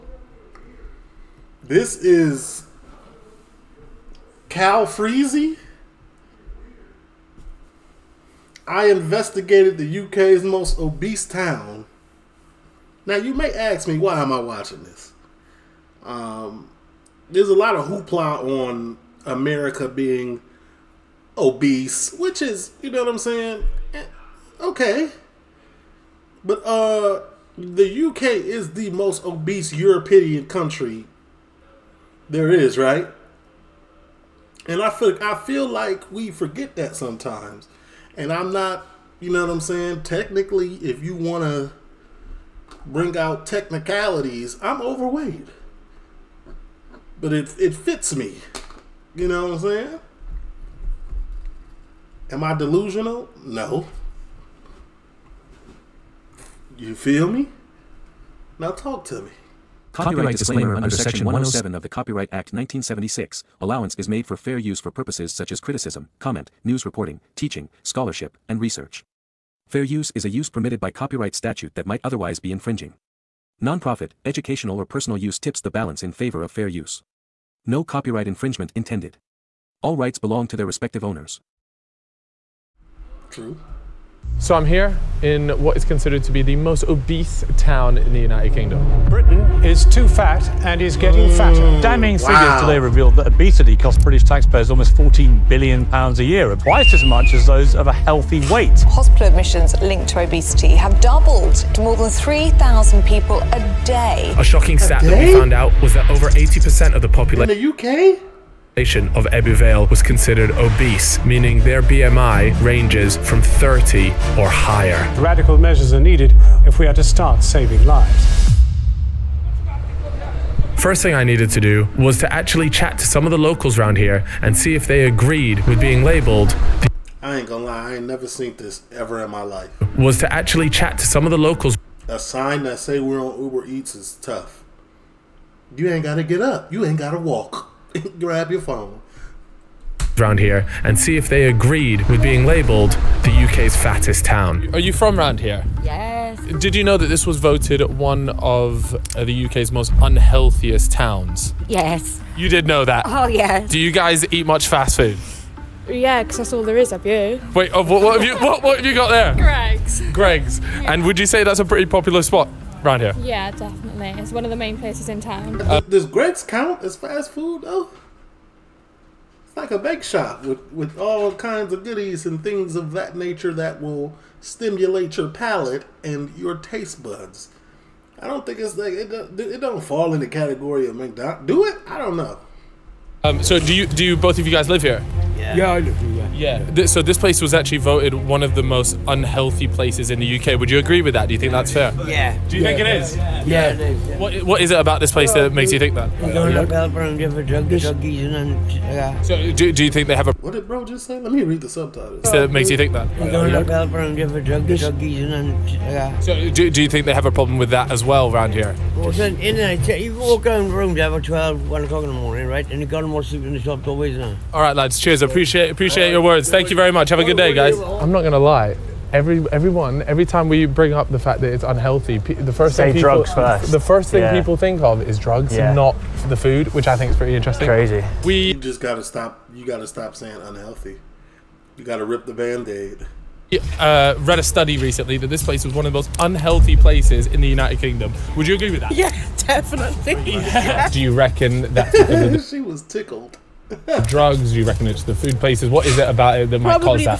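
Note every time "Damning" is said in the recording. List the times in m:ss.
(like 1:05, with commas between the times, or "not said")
1:31.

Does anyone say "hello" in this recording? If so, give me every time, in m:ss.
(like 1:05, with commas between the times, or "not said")
not said.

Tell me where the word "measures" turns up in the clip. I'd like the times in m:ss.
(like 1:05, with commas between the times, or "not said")
1:55.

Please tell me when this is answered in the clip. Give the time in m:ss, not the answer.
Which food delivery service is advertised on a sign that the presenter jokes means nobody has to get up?
2:13.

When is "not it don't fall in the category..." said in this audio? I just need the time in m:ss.
2:59.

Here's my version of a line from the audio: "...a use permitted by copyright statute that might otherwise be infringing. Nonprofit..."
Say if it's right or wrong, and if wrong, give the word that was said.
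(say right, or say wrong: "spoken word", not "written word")
right.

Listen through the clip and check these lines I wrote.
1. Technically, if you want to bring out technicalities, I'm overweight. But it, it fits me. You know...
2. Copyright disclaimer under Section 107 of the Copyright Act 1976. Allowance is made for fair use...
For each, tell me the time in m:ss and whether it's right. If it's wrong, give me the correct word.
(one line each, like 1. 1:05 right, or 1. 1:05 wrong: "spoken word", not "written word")
1. 0:40 right
2. 0:59 right.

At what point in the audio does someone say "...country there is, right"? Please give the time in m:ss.
0:30.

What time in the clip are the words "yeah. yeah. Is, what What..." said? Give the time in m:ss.
3:13.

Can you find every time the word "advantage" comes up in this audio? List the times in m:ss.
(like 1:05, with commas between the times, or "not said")
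not said.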